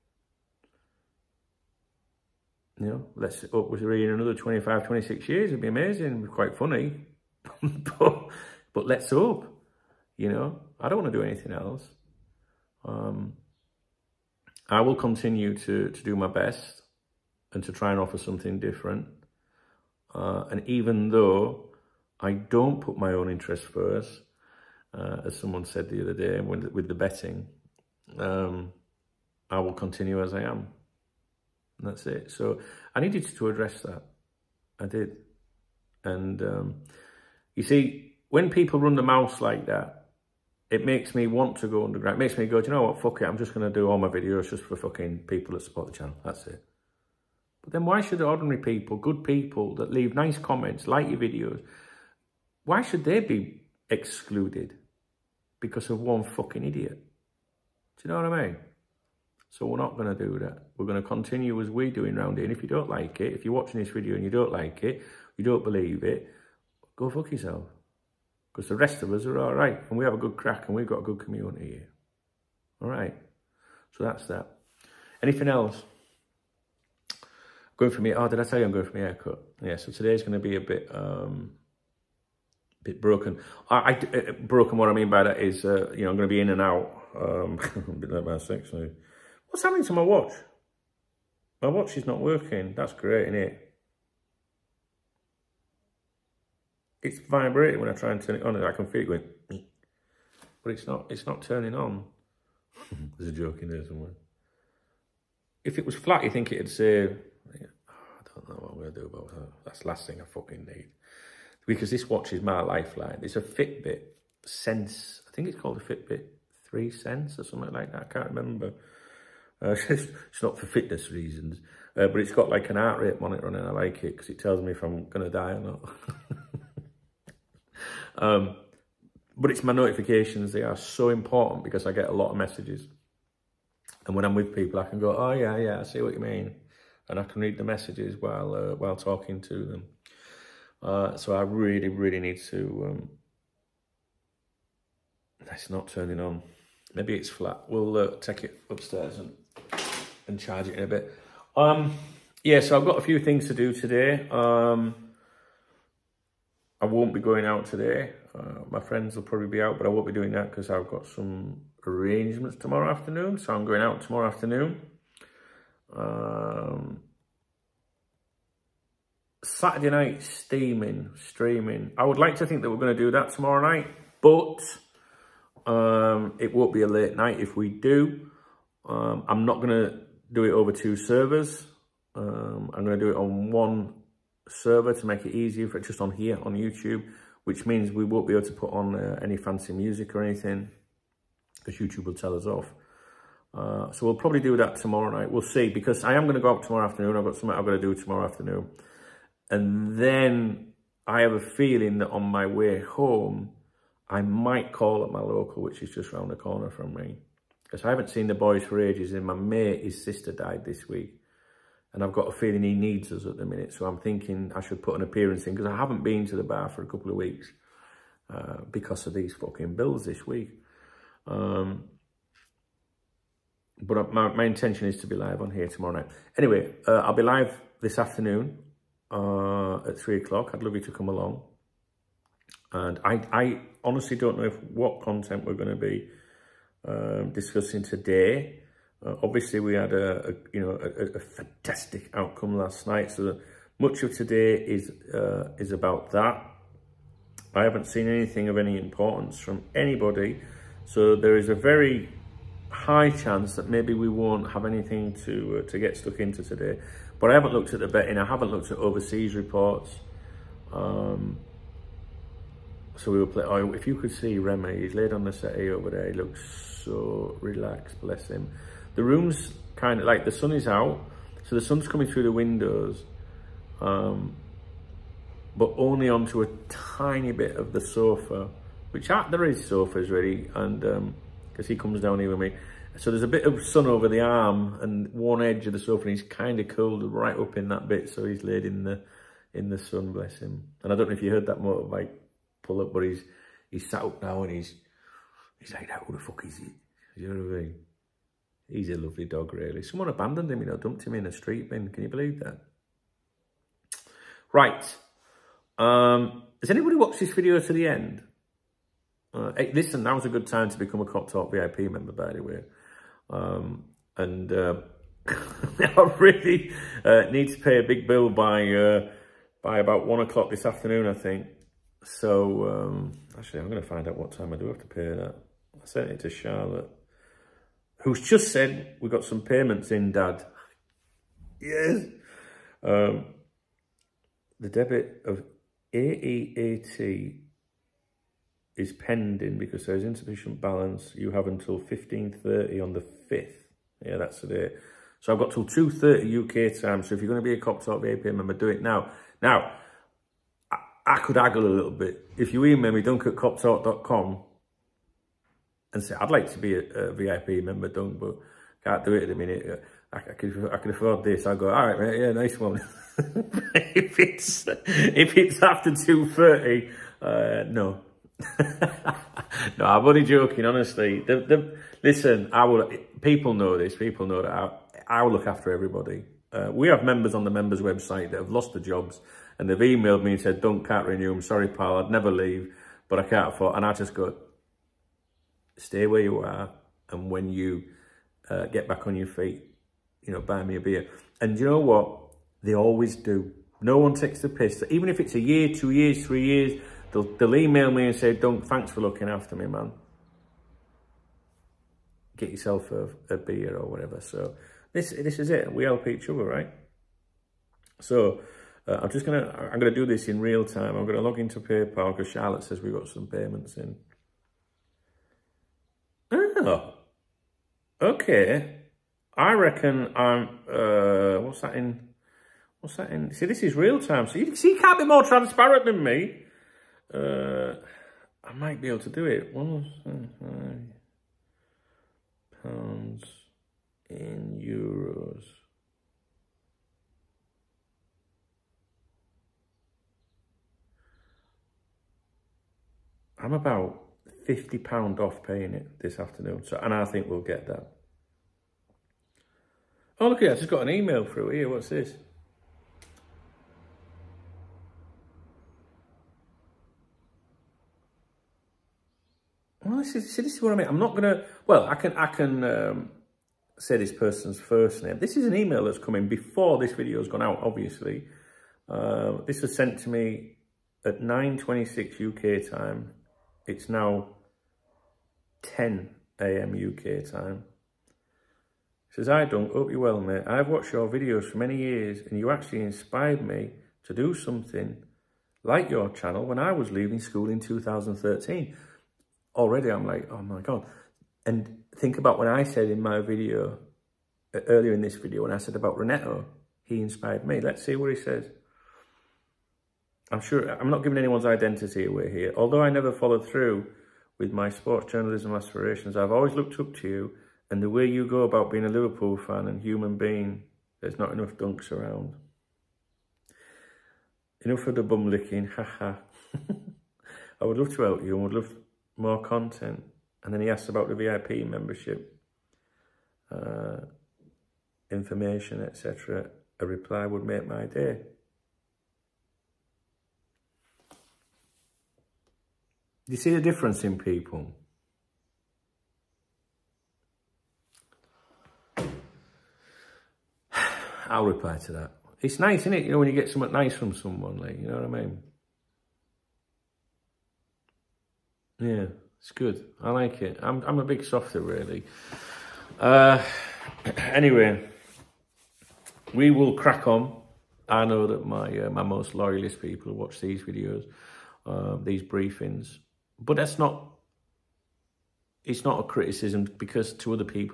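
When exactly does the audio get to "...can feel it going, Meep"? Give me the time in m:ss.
1:38.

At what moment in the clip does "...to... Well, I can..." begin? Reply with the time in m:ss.
7:41.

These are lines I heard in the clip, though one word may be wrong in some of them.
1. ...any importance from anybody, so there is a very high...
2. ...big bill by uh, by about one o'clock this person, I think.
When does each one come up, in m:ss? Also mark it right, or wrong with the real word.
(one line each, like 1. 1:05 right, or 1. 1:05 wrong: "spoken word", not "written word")
1. 4:08 right
2. 5:17 wrong: "afternoon", not "person".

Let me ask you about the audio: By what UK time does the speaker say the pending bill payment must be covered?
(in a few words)
2:30.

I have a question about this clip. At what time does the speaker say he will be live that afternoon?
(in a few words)
3 o'clock.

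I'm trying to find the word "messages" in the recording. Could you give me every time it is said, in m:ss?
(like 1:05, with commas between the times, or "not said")
2:12, 2:17.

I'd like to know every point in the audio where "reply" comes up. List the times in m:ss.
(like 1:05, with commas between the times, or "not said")
8:46, 9:01.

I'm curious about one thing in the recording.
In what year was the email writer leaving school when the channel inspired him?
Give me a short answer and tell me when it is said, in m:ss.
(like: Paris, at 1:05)
2013, at 8:07.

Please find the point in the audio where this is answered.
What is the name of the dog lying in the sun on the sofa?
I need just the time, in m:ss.
4:24.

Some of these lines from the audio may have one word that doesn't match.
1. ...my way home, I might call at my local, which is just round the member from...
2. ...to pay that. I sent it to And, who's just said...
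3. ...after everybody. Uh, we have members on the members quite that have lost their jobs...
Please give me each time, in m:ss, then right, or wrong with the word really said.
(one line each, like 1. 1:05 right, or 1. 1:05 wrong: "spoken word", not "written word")
1. 3:22 wrong: "corner", not "member"
2. 5:24 wrong: "Charlotte", not "And"
3. 6:15 wrong: "website", not "quite".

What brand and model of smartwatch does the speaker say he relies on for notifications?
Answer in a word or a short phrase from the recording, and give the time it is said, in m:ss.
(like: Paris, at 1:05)
Fitbit Sense, at 1:53.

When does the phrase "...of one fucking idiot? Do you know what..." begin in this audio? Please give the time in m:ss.
0:55.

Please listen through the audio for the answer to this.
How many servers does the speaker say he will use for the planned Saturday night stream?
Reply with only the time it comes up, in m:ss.
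3:03.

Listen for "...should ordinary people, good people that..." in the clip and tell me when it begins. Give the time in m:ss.
0:48.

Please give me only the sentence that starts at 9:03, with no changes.
You know, when you get something nice from someone, like, you know what I mean?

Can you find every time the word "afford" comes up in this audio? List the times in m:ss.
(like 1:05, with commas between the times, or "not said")
6:00, 6:23.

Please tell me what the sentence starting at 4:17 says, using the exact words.
But I haven't looked at the betting.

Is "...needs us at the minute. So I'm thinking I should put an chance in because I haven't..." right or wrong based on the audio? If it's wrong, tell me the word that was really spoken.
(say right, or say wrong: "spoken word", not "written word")
wrong: "appearance", not "chance".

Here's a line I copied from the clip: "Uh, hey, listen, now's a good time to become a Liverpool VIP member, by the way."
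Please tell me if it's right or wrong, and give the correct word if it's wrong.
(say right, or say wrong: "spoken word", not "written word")
wrong: "KopTalk", not "Liverpool".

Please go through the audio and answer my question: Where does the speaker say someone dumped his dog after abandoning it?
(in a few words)
a street bin.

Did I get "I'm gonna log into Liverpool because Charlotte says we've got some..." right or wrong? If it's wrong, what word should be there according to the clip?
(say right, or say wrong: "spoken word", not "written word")
wrong: "PayPal", not "Liverpool".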